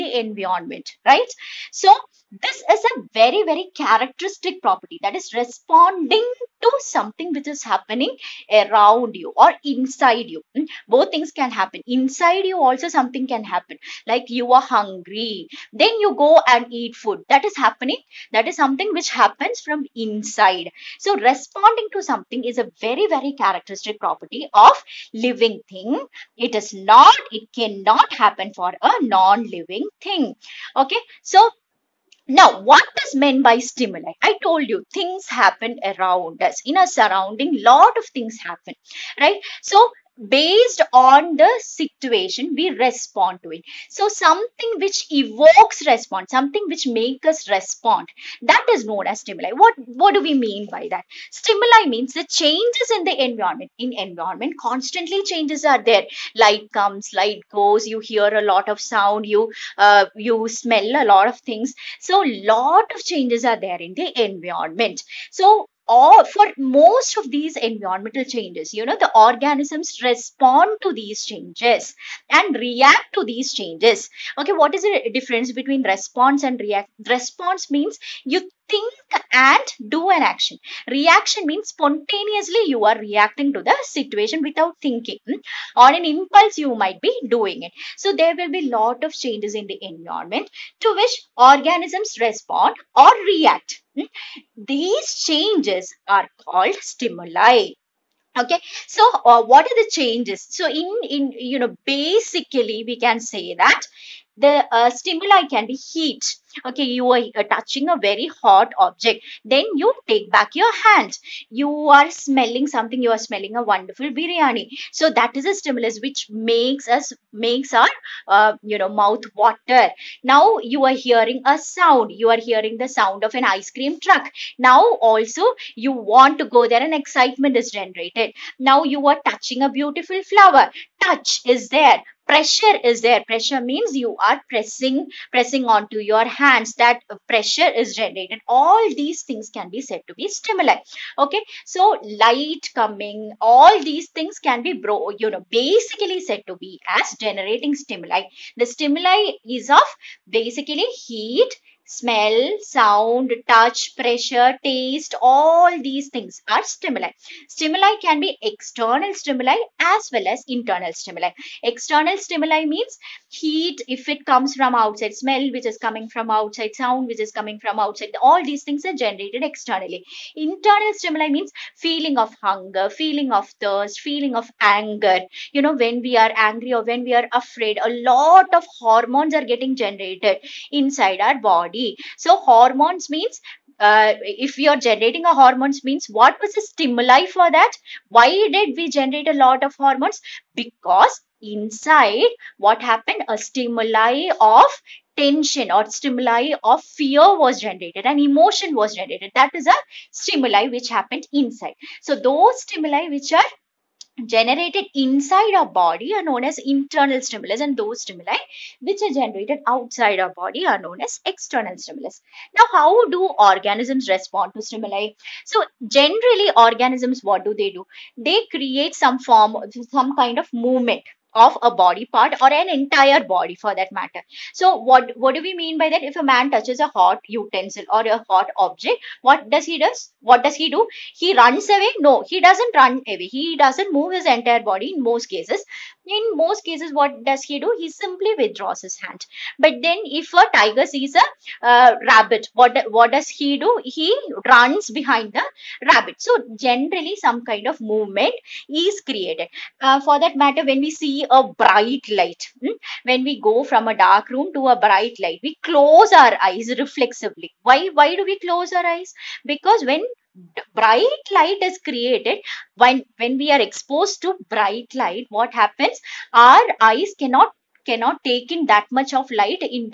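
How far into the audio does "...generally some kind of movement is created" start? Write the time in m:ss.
4:06.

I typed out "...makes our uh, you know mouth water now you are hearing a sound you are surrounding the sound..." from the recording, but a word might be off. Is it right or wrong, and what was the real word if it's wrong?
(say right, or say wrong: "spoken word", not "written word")
wrong: "hearing", not "surrounding".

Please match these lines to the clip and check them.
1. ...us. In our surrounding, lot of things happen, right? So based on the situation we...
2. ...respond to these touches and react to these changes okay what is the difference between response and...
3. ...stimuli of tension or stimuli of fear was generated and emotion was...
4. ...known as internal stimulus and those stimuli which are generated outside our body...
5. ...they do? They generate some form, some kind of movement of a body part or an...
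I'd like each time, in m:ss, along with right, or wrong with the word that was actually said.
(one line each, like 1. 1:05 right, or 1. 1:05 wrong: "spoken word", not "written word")
1. 0:36 right
2. 1:10 wrong: "changes", not "touches"
3. 3:13 right
4. 3:26 right
5. 3:37 wrong: "create", not "generate".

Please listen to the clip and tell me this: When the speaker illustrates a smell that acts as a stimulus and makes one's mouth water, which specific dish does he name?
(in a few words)
biryani.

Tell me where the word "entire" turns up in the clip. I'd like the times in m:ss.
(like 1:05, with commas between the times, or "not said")
3:42, 3:54.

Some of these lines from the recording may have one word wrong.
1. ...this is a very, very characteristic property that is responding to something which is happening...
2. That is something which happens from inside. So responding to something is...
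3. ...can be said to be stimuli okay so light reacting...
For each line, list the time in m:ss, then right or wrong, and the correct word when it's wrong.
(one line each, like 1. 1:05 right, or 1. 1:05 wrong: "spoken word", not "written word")
1. 0:02 right
2. 0:18 right
3. 2:19 wrong: "coming", not "reacting".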